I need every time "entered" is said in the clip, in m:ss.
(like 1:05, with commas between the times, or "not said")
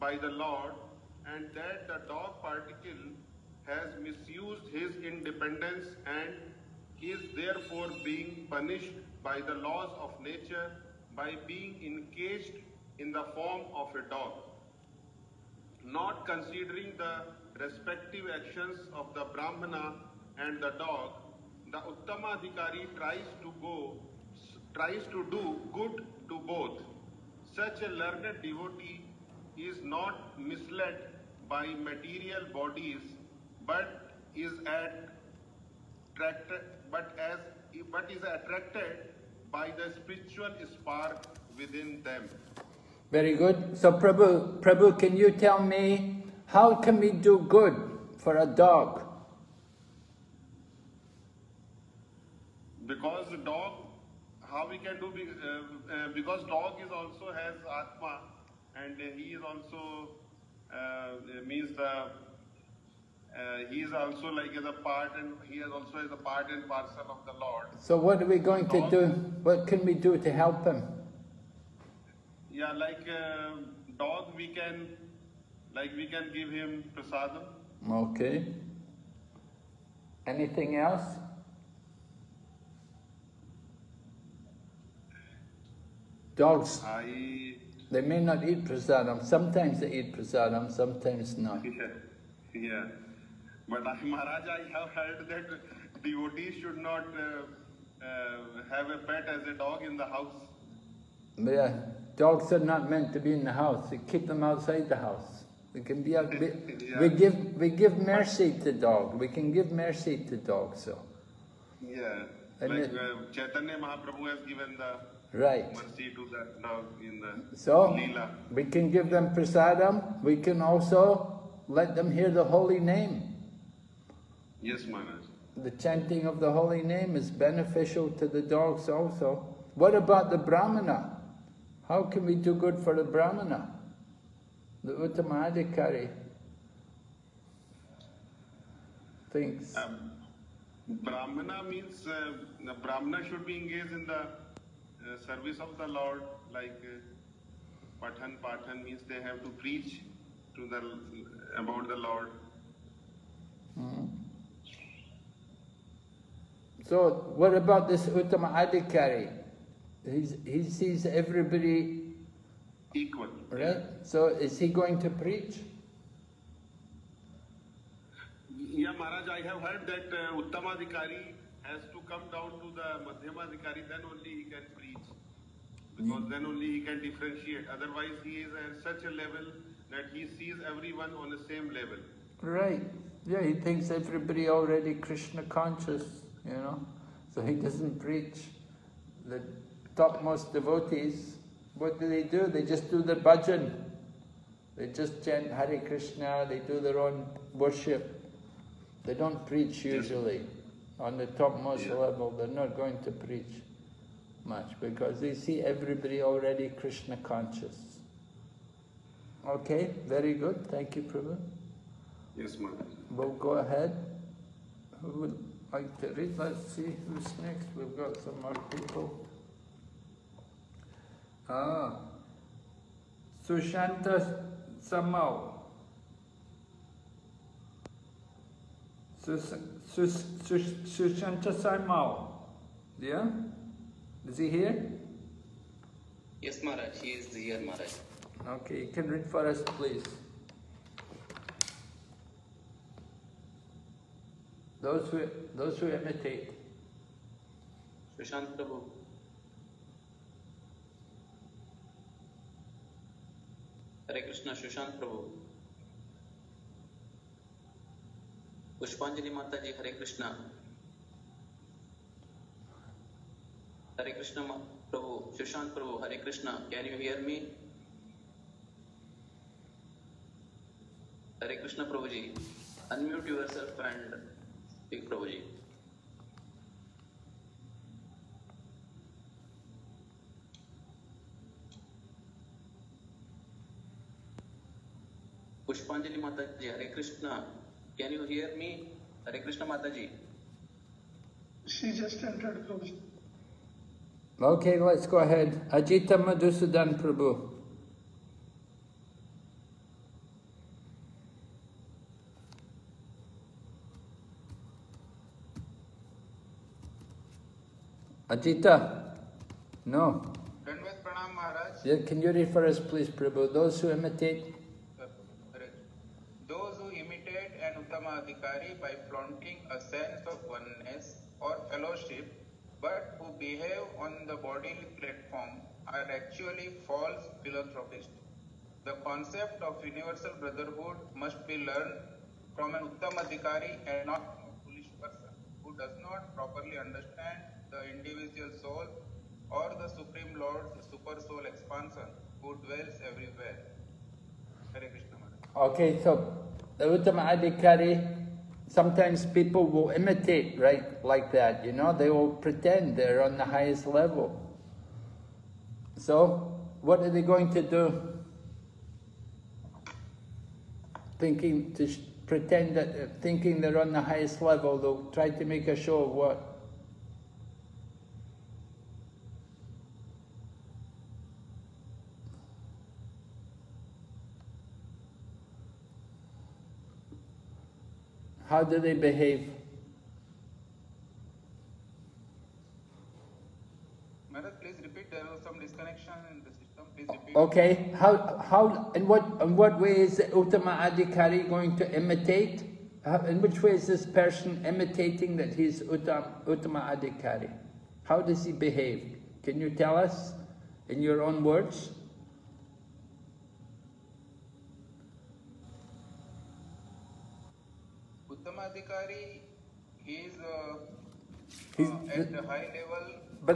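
4:52.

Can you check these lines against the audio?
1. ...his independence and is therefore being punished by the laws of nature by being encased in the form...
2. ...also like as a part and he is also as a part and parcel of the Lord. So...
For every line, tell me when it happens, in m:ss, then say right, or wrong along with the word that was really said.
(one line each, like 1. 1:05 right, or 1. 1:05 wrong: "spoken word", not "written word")
1. 0:04 right
2. 1:03 right.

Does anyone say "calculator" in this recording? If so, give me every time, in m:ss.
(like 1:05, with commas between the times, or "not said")
not said.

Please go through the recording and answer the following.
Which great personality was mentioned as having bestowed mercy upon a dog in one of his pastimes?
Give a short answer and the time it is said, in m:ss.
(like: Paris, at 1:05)
Chaitanya Mahaprabhu, at 1:53.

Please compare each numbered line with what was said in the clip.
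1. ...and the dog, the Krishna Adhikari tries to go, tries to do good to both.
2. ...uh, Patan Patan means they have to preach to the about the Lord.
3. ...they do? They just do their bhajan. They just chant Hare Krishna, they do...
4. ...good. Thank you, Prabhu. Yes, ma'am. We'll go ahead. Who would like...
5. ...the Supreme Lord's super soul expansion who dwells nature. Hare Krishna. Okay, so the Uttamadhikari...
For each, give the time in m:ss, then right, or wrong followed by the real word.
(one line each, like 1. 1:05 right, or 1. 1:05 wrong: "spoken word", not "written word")
1. 0:20 wrong: "Uttama", not "Krishna"
2. 2:26 right
3. 3:12 right
4. 3:30 right
5. 5:39 wrong: "everywhere", not "nature".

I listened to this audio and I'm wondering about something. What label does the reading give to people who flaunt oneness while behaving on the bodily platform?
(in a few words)
False philanthropists.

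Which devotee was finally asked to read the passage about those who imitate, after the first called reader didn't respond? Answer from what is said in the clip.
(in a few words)
Ajita Madhusudan Prabhu.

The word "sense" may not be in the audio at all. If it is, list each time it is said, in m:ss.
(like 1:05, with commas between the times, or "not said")
5:19.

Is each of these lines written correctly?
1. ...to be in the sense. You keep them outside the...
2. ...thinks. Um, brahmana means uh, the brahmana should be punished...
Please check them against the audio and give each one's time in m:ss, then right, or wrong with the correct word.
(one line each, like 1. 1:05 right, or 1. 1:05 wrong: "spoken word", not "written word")
1. 1:43 wrong: "house", not "sense"
2. 2:19 wrong: "engaged", not "punished".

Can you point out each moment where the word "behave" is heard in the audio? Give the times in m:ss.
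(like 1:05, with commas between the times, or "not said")
5:23, 6:18, 6:38.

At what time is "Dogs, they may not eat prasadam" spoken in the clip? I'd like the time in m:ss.
1:26.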